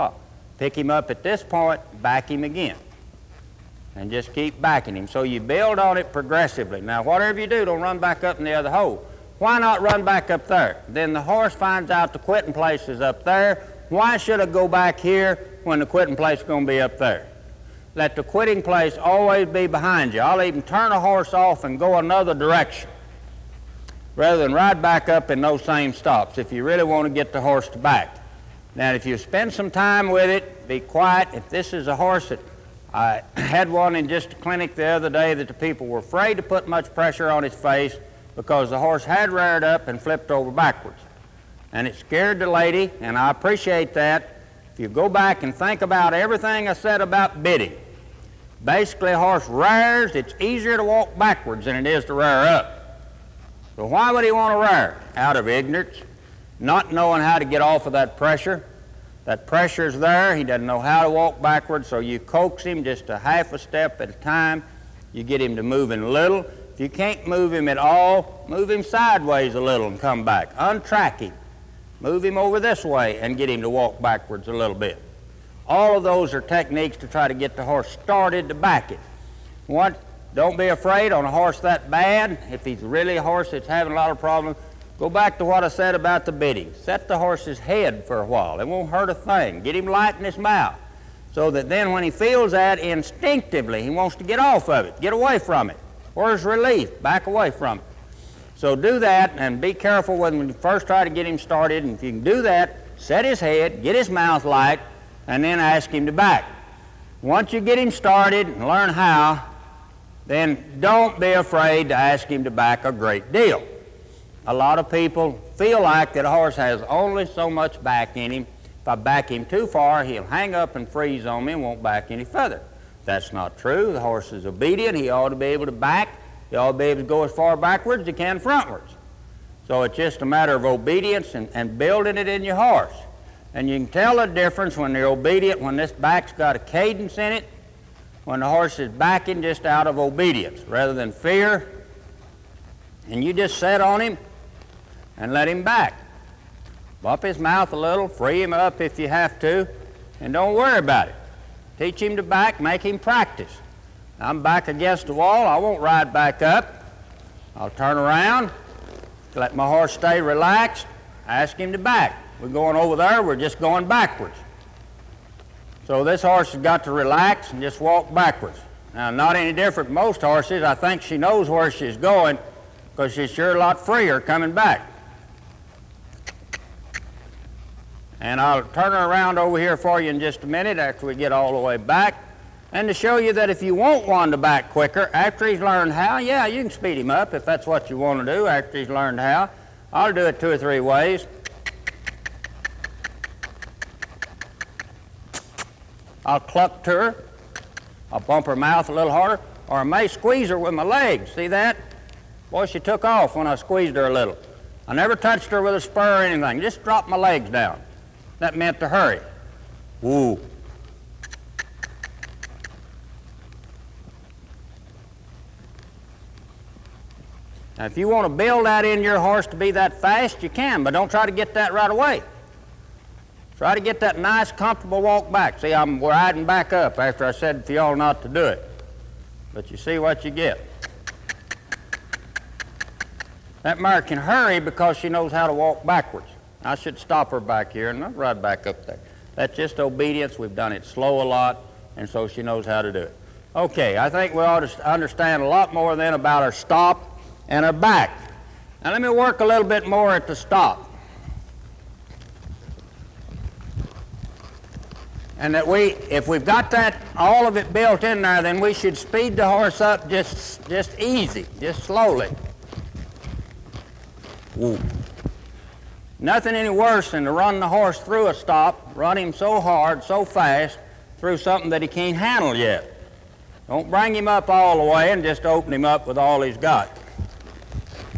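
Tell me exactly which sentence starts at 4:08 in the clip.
Now let me work a little bit more at the stop.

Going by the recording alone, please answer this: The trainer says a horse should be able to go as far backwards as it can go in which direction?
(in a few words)
Frontwards.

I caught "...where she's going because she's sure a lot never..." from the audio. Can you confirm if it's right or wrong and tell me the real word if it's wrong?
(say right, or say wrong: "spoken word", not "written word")
wrong: "freer", not "never".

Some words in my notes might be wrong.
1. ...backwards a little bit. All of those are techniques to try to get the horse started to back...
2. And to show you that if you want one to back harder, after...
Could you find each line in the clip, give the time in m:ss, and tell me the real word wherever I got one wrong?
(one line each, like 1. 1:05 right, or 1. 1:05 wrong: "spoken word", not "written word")
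1. 1:13 right
2. 3:02 wrong: "quicker", not "harder".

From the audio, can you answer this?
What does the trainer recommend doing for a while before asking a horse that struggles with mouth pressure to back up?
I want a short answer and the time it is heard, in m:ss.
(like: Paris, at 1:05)
Set the horse's head, at 1:26.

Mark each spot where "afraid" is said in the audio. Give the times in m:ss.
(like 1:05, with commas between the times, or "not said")
0:35, 1:20, 1:51.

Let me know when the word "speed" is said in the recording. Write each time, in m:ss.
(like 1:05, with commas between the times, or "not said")
3:06, 4:18.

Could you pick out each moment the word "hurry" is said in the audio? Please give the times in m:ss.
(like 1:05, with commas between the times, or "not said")
3:28, 3:54.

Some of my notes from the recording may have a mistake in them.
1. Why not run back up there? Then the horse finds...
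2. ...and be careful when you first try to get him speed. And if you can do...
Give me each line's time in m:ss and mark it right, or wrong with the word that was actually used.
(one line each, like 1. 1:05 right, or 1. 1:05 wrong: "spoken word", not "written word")
1. 0:09 right
2. 1:39 wrong: "started", not "speed".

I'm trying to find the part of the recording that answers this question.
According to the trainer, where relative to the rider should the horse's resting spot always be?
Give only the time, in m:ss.
0:19.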